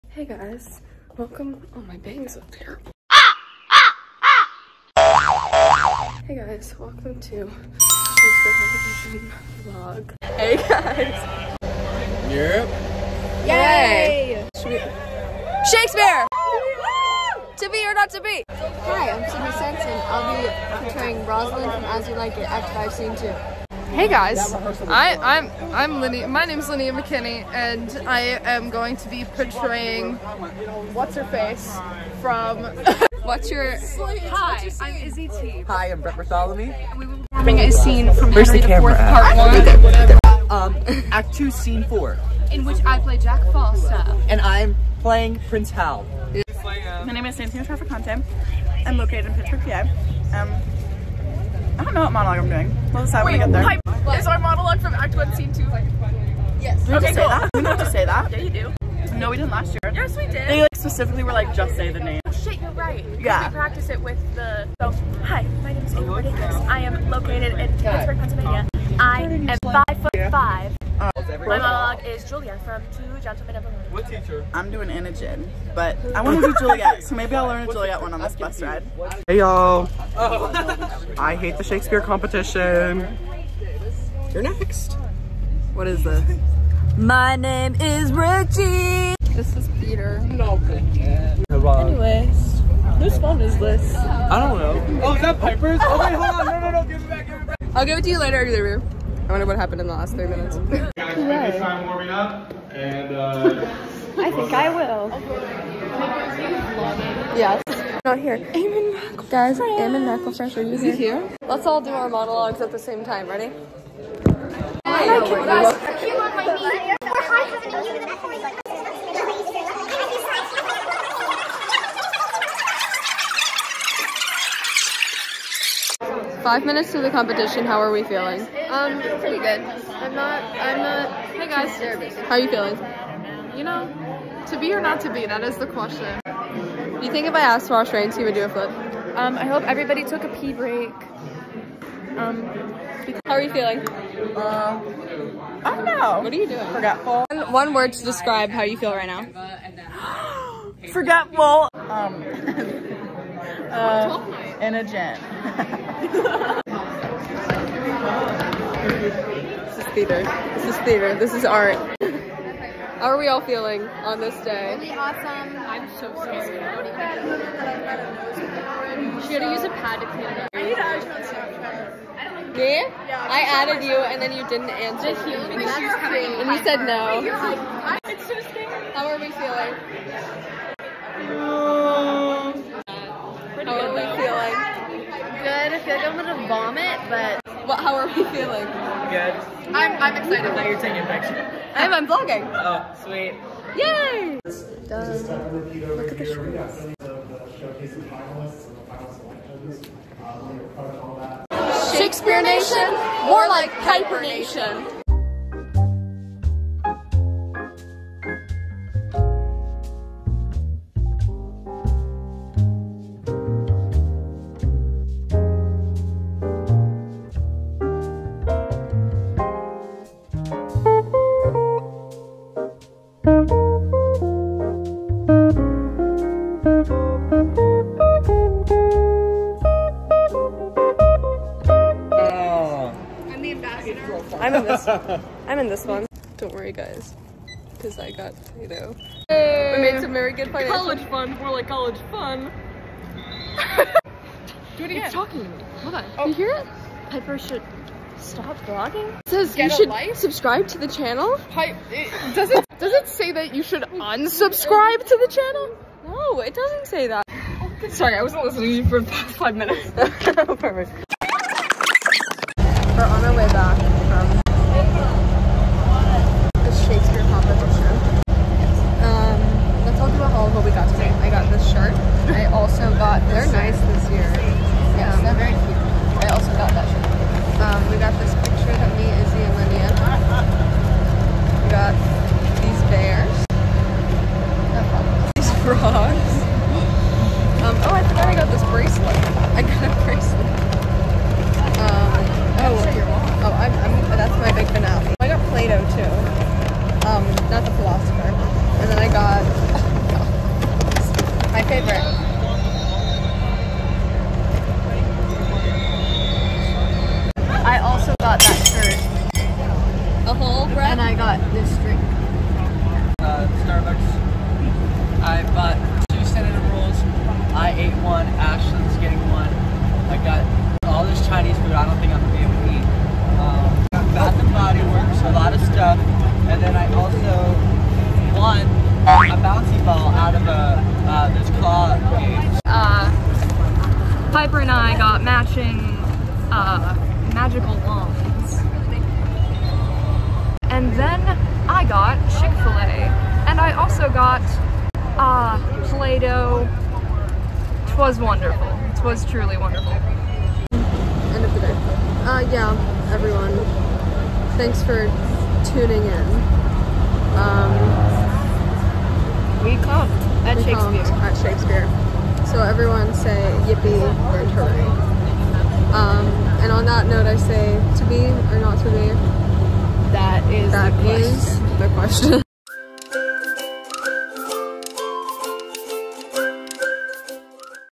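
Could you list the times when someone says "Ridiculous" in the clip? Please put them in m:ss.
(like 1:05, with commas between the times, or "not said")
1:06.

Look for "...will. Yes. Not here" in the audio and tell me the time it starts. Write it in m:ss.
1:44.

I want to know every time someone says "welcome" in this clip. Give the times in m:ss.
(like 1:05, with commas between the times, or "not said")
0:01, 0:06.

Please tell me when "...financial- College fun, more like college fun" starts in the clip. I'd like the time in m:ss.
4:00.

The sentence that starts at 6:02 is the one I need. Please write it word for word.
So everyone say yippee or hooray.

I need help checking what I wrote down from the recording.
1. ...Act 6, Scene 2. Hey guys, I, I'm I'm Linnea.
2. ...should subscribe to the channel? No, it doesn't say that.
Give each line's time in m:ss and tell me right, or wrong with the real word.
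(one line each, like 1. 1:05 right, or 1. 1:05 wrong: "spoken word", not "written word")
1. 0:22 wrong: "5", not "6"
2. 4:13 wrong: "unsubscribe", not "subscribe".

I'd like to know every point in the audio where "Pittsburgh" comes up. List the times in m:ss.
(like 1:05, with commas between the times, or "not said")
0:49, 1:07.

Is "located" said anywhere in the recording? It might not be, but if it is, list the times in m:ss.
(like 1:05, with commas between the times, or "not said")
0:48, 1:07.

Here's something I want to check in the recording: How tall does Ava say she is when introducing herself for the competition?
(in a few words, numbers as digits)
5 foot 5.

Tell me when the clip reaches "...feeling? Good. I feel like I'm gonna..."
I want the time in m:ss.
3:03.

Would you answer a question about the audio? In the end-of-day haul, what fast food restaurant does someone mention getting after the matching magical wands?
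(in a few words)
Chick-fil-A.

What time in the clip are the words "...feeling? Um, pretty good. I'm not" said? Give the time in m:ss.
2:08.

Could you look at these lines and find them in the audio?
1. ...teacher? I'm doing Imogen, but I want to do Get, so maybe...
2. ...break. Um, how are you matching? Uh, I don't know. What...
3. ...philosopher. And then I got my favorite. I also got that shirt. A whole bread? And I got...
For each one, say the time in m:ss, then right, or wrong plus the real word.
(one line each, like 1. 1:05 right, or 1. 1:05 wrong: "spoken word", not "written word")
1. 1:14 wrong: "Juliet", not "Get"
2. 2:20 wrong: "feeling", not "matching"
3. 4:57 right.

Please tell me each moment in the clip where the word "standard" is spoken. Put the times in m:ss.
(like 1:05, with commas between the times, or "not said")
5:16.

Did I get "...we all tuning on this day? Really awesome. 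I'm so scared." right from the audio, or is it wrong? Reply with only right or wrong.
wrong.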